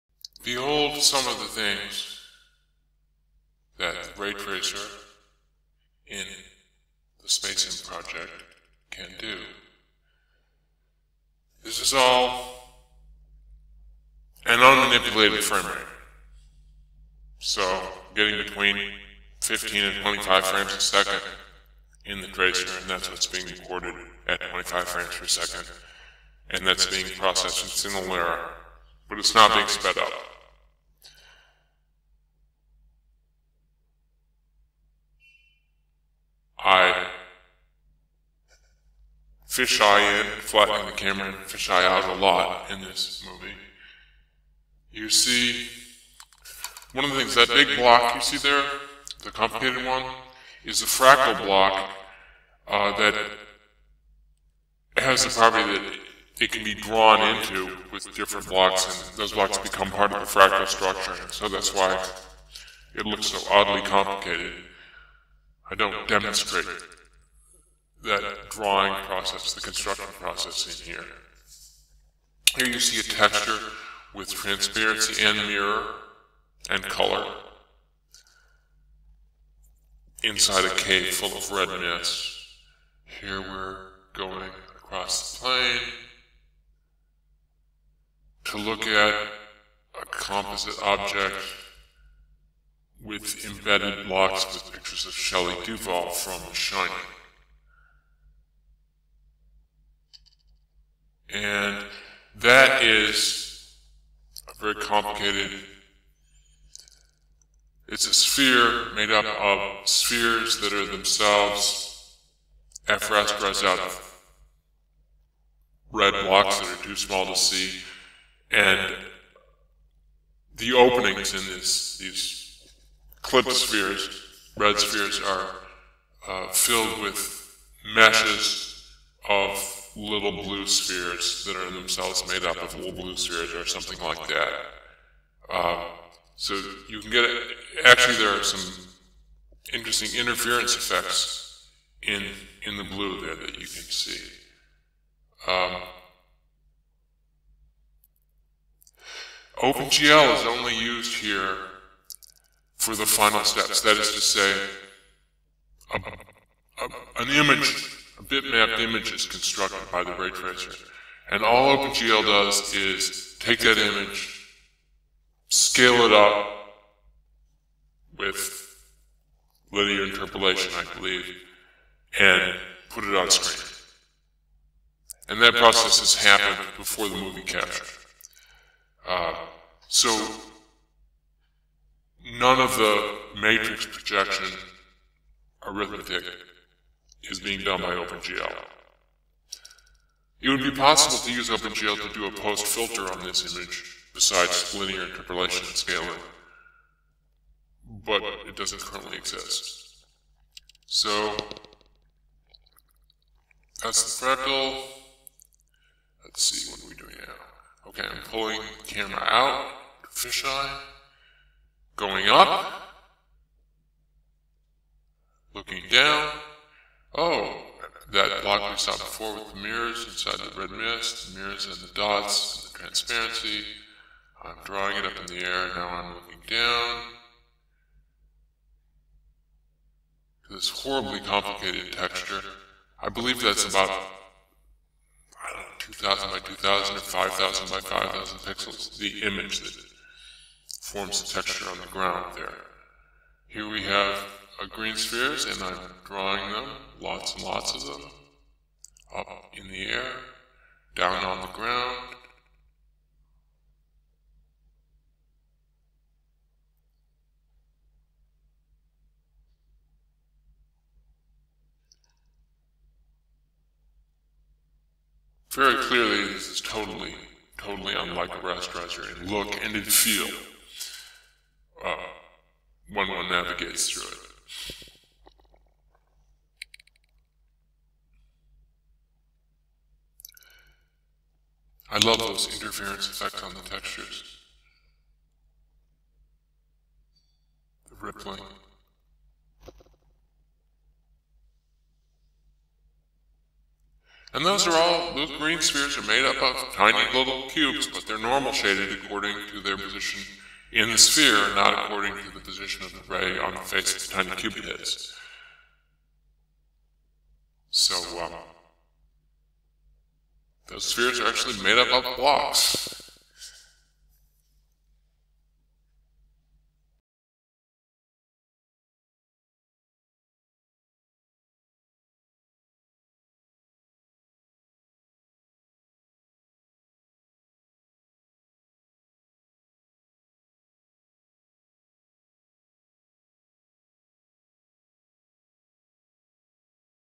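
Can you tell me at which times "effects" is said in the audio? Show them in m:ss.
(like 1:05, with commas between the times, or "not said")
2:20, 4:43.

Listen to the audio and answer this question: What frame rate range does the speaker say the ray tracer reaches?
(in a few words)
15 to 25.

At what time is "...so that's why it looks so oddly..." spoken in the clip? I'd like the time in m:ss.
1:01.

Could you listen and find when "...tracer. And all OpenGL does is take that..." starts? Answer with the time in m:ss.
2:40.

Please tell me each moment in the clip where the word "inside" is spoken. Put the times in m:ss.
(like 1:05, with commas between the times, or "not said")
1:20, 3:40.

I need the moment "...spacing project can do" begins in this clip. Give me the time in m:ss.
0:07.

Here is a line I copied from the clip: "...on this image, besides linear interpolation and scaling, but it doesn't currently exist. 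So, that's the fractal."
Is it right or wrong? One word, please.
right.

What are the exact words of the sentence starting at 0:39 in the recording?
fisheye in, flatten the camera and fisheye out a lot in this movie.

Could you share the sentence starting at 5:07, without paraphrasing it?
So, um, the spheres are actually made up of blocks.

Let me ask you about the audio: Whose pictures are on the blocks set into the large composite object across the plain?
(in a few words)
Shelley Duvall.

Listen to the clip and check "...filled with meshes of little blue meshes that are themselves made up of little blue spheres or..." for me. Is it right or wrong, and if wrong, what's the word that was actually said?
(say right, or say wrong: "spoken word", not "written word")
wrong: "spheres", not "meshes".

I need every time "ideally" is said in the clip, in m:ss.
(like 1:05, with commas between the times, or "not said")
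not said.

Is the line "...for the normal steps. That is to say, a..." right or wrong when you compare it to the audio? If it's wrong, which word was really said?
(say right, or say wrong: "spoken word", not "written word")
wrong: "final", not "normal".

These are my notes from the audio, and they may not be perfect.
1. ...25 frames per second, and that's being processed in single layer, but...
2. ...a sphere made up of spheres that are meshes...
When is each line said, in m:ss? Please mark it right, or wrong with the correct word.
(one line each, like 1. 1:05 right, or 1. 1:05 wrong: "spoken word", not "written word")
1. 0:24 right
2. 1:48 wrong: "themselves", not "meshes".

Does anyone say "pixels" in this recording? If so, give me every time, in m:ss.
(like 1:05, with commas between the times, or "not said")
3:58.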